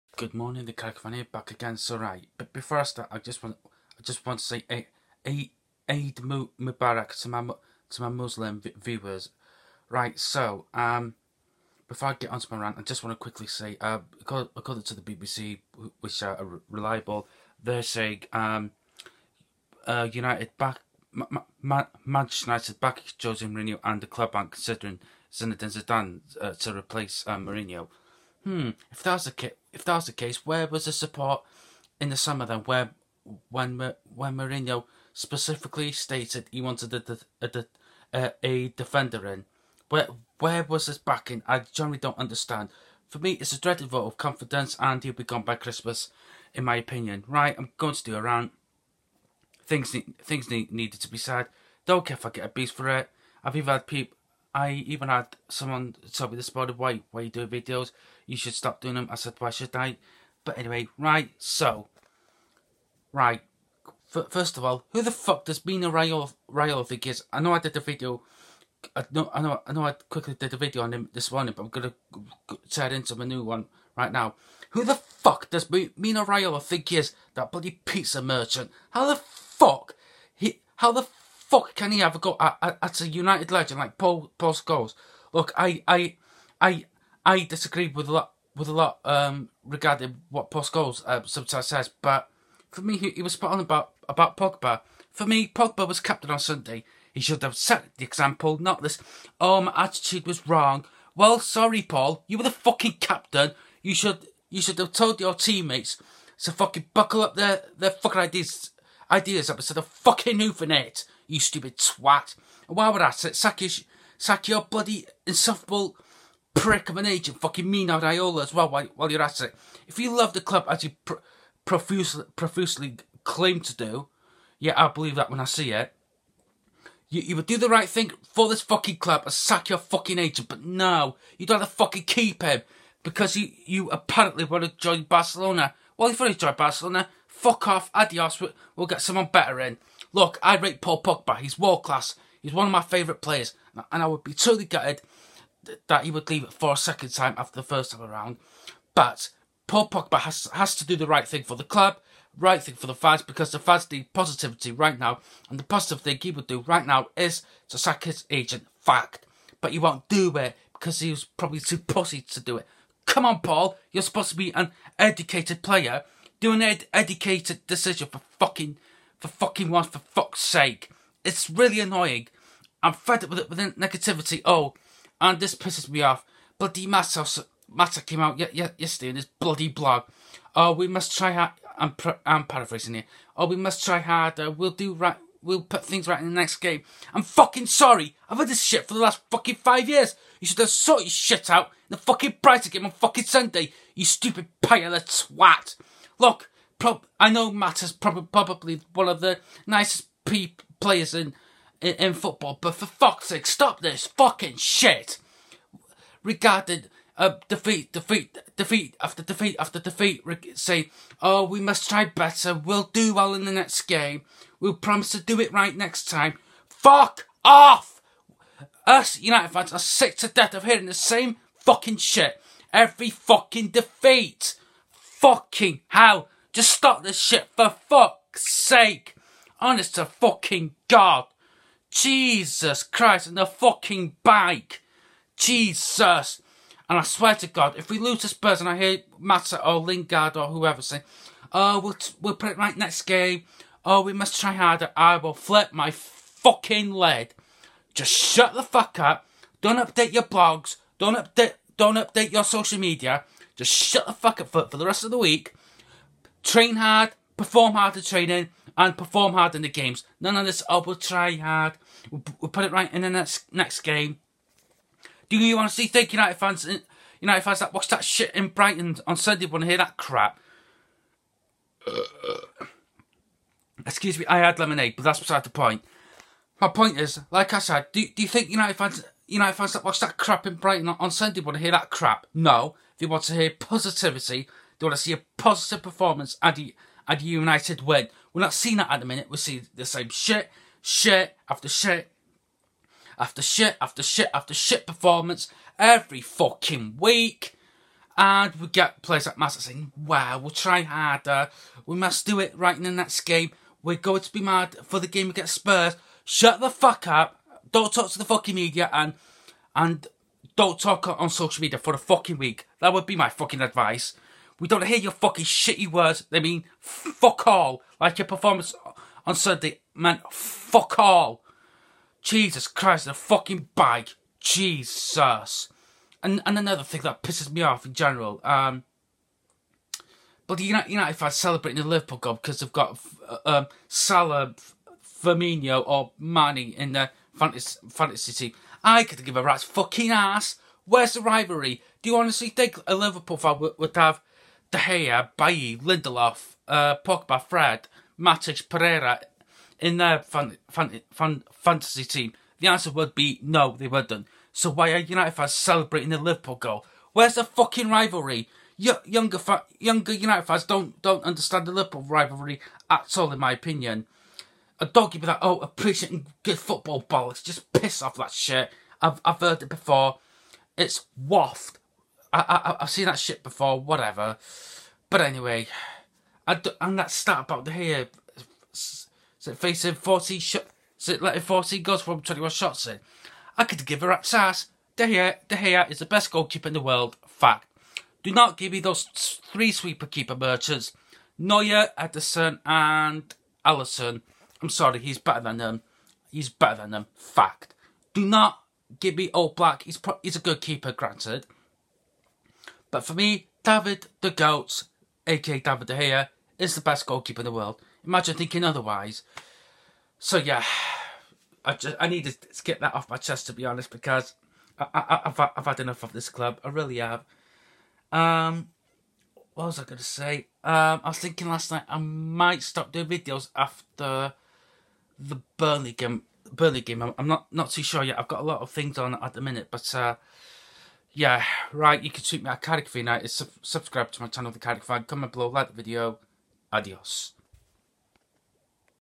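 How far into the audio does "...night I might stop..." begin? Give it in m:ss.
7:01.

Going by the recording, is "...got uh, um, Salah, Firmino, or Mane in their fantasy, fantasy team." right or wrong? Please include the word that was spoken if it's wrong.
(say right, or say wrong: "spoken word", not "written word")
right.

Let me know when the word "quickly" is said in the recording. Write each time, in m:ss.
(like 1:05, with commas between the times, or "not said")
0:13, 1:10.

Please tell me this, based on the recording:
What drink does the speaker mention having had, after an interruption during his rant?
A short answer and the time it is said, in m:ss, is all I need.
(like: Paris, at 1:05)
lemonade, at 4:34.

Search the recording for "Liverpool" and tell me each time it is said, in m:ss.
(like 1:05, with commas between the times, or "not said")
5:31, 5:42, 5:56, 6:01.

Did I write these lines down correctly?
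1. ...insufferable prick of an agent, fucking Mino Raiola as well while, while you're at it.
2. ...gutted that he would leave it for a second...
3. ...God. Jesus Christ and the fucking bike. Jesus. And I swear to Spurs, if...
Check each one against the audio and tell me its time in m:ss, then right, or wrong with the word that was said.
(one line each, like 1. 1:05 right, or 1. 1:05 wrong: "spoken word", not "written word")
1. 1:55 right
2. 2:24 right
3. 3:50 wrong: "God", not "Spurs".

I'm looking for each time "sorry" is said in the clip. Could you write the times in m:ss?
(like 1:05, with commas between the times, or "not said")
1:41, 3:07, 6:34.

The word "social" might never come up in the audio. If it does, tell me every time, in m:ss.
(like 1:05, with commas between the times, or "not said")
4:12, 5:11.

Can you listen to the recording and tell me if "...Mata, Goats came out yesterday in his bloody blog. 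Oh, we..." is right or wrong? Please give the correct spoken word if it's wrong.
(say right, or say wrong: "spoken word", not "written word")
wrong: "Mata", not "Goats".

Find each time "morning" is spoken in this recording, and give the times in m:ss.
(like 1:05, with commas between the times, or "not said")
0:00, 1:11.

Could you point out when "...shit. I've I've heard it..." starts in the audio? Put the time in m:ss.
6:08.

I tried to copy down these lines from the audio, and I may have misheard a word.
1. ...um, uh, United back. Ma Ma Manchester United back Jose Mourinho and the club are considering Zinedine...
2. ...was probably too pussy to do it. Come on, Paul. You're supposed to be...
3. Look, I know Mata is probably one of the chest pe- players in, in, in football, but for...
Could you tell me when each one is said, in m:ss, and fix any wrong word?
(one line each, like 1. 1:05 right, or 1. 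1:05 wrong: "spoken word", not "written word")
1. 0:18 right
2. 2:41 right
3. 3:16 wrong: "nicest", not "chest".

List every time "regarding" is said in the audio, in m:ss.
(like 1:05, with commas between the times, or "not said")
1:29, 3:26.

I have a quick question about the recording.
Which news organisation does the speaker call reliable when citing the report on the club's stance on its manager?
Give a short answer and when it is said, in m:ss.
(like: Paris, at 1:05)
BBC, at 0:15.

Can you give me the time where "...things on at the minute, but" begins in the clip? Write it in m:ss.
7:08.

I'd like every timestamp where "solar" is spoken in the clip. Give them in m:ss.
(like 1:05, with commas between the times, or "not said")
not said.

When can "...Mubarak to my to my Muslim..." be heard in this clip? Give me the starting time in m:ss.
0:06.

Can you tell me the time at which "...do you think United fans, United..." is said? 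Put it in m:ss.
4:38.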